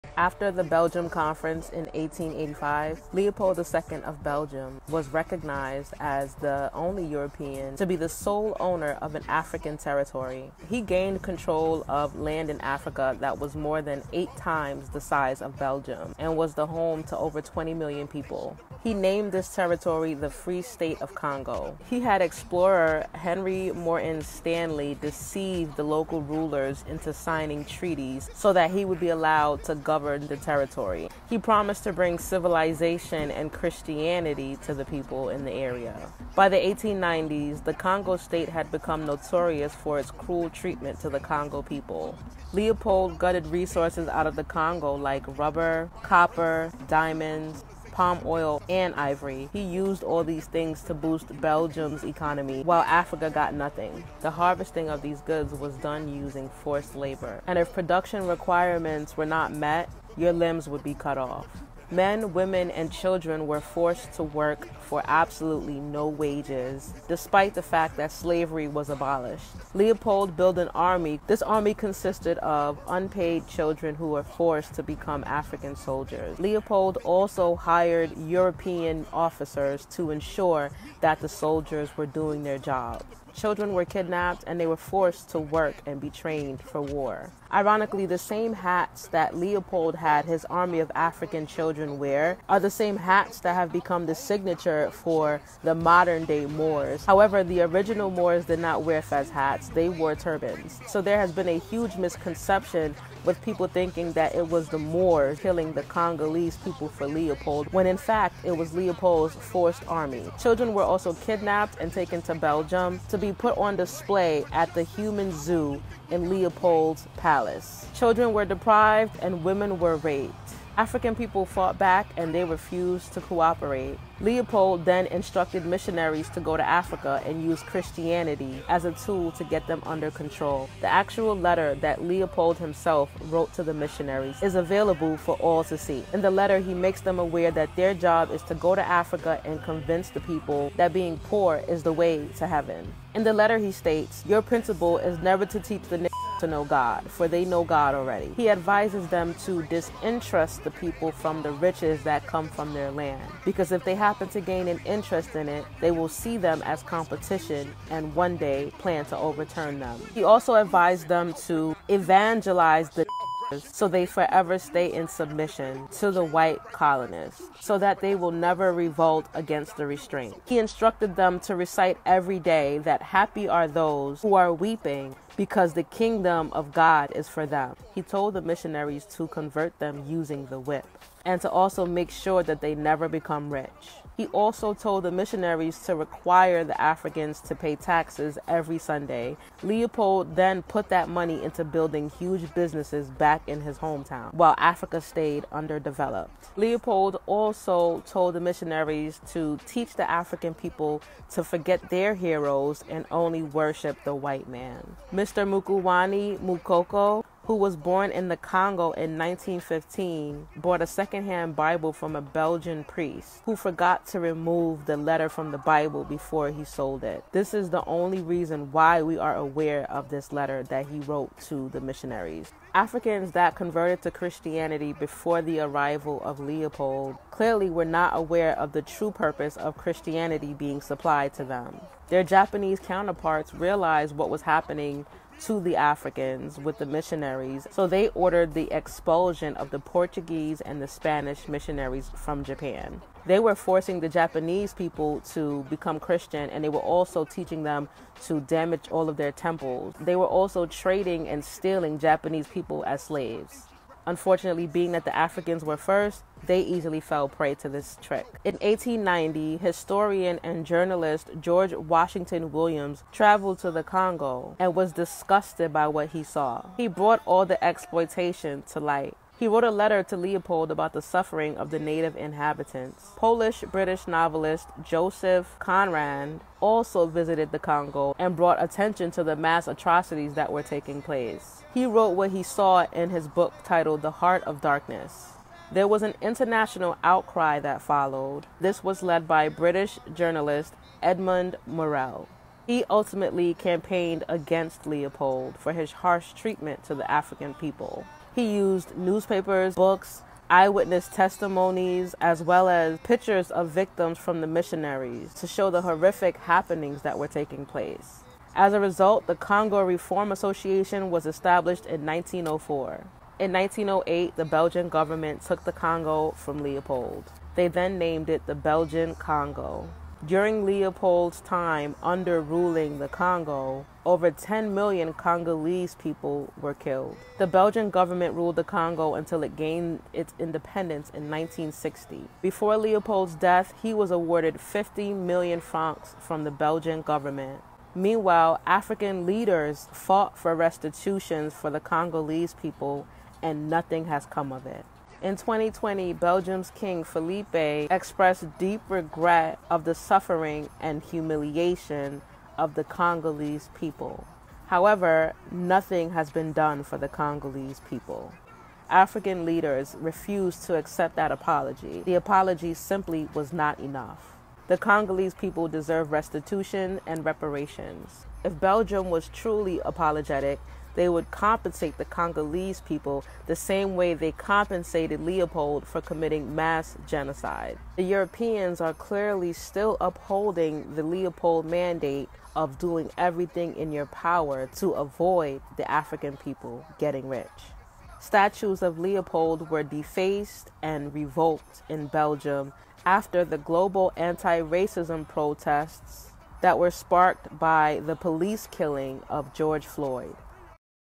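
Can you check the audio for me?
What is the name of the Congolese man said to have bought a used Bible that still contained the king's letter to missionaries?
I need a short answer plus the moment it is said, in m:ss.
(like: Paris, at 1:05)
Mukuwani Mukoko, at 3:25.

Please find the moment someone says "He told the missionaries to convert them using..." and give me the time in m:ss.
2:57.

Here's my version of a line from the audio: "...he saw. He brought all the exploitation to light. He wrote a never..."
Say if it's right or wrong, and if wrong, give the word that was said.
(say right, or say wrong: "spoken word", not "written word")
wrong: "letter", not "never".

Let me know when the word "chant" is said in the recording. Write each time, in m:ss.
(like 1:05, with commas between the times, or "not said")
not said.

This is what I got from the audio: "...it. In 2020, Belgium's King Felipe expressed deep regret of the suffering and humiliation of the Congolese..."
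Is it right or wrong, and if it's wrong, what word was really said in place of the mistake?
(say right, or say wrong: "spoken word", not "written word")
right.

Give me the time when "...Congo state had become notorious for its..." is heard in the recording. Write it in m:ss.
0:37.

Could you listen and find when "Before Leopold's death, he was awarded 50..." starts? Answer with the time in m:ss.
5:32.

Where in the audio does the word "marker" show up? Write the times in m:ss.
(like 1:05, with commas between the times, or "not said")
not said.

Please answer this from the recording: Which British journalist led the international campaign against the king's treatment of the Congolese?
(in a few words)
Edmund Morel.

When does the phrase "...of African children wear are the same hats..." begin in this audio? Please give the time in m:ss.
1:30.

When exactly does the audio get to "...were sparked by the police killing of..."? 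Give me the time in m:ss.
6:36.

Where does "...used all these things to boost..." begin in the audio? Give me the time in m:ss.
0:49.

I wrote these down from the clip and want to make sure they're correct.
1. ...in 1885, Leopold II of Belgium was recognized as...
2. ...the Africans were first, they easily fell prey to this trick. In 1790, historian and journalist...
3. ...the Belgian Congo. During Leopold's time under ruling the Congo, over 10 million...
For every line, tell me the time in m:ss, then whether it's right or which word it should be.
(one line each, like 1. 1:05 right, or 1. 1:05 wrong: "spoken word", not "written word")
1. 0:01 right
2. 4:15 wrong: "1890", not "1790"
3. 5:18 right.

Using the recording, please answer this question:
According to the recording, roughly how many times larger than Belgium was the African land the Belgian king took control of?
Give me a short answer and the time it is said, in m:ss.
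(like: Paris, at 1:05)
8 times, at 0:14.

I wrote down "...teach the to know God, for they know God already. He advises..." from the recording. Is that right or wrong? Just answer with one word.
right.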